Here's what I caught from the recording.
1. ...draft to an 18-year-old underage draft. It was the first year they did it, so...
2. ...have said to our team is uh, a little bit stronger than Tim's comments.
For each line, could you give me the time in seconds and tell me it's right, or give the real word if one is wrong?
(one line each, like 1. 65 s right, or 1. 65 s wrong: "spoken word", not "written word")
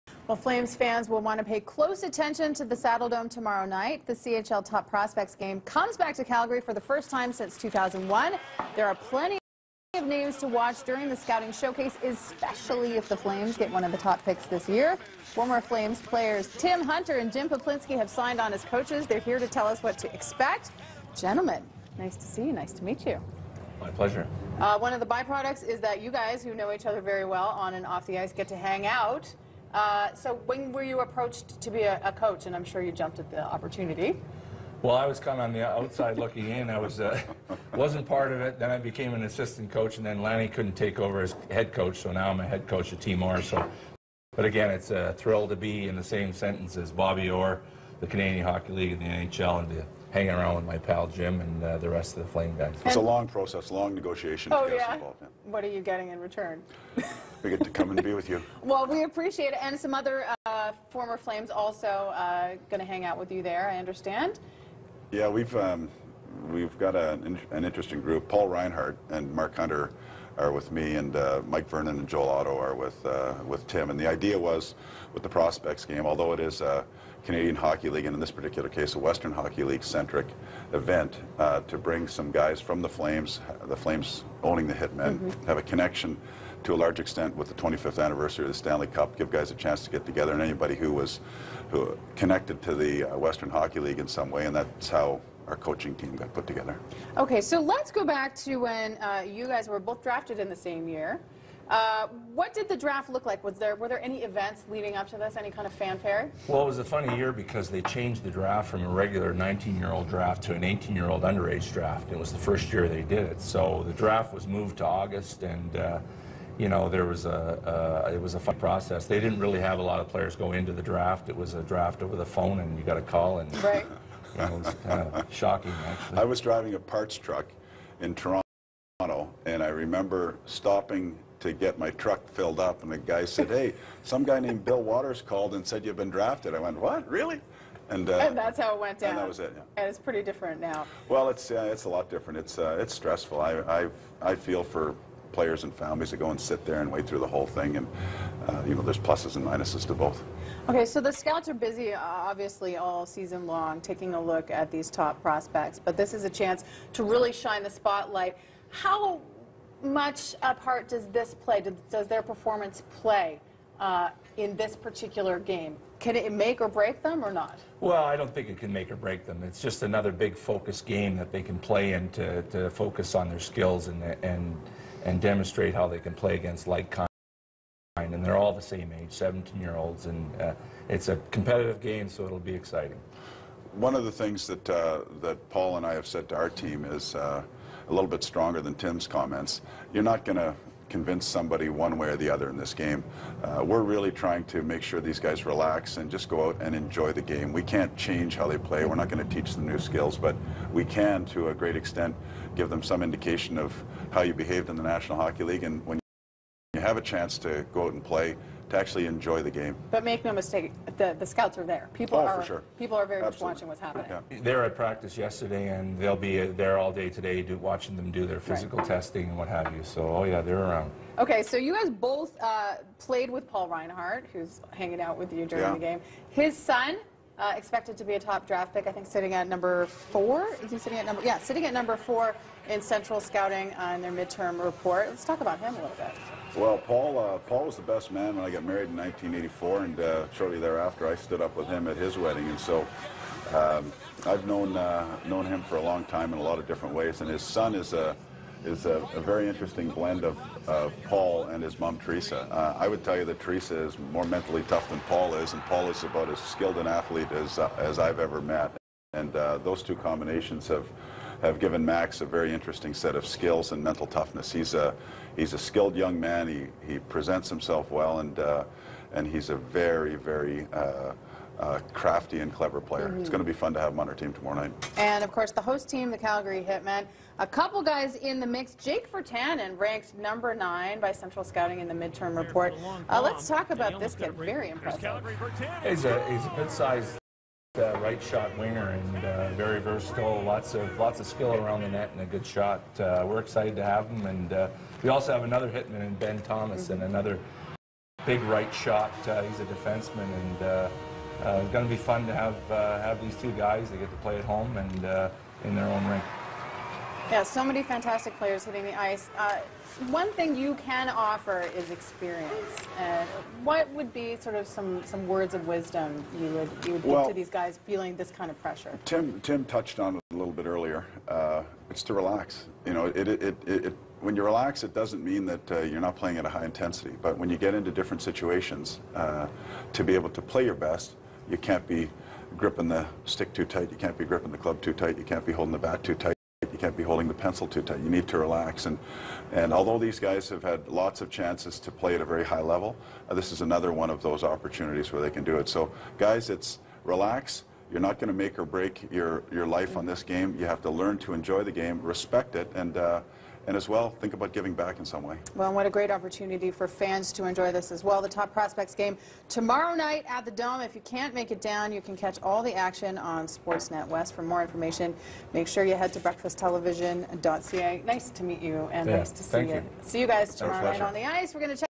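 1. 110 s right
2. 185 s right.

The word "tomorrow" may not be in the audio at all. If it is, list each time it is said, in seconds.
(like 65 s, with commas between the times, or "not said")
3 s, 274 s, 359 s, 370 s.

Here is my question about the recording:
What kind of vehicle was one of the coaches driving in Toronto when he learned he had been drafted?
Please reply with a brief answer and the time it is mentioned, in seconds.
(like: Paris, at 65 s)
A parts truck, at 126 s.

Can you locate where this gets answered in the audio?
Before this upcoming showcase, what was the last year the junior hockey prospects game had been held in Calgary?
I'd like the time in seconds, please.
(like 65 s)
7 s.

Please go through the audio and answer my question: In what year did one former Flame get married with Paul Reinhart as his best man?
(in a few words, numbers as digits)
1984.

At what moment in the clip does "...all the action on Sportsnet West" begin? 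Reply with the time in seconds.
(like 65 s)
362 s.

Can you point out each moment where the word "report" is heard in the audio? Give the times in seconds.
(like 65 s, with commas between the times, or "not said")
234 s, 282 s.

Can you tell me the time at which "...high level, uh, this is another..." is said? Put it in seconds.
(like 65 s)
342 s.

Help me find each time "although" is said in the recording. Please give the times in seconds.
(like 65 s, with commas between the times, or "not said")
76 s, 339 s.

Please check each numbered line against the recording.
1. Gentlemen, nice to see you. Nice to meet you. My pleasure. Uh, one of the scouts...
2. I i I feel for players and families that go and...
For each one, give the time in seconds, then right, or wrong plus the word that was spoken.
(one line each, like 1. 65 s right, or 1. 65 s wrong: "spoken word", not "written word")
1. 21 s wrong: "byproducts", not "scouts"
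2. 143 s right.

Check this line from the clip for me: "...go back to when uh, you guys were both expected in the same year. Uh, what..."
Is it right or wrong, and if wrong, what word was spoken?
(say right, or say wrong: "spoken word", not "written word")
wrong: "drafted", not "expected".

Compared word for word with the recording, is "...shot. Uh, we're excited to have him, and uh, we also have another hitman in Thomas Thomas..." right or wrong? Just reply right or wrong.
wrong.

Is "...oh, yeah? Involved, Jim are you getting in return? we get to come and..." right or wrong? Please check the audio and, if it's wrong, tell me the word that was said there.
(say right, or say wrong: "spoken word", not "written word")
wrong: "What", not "Jim".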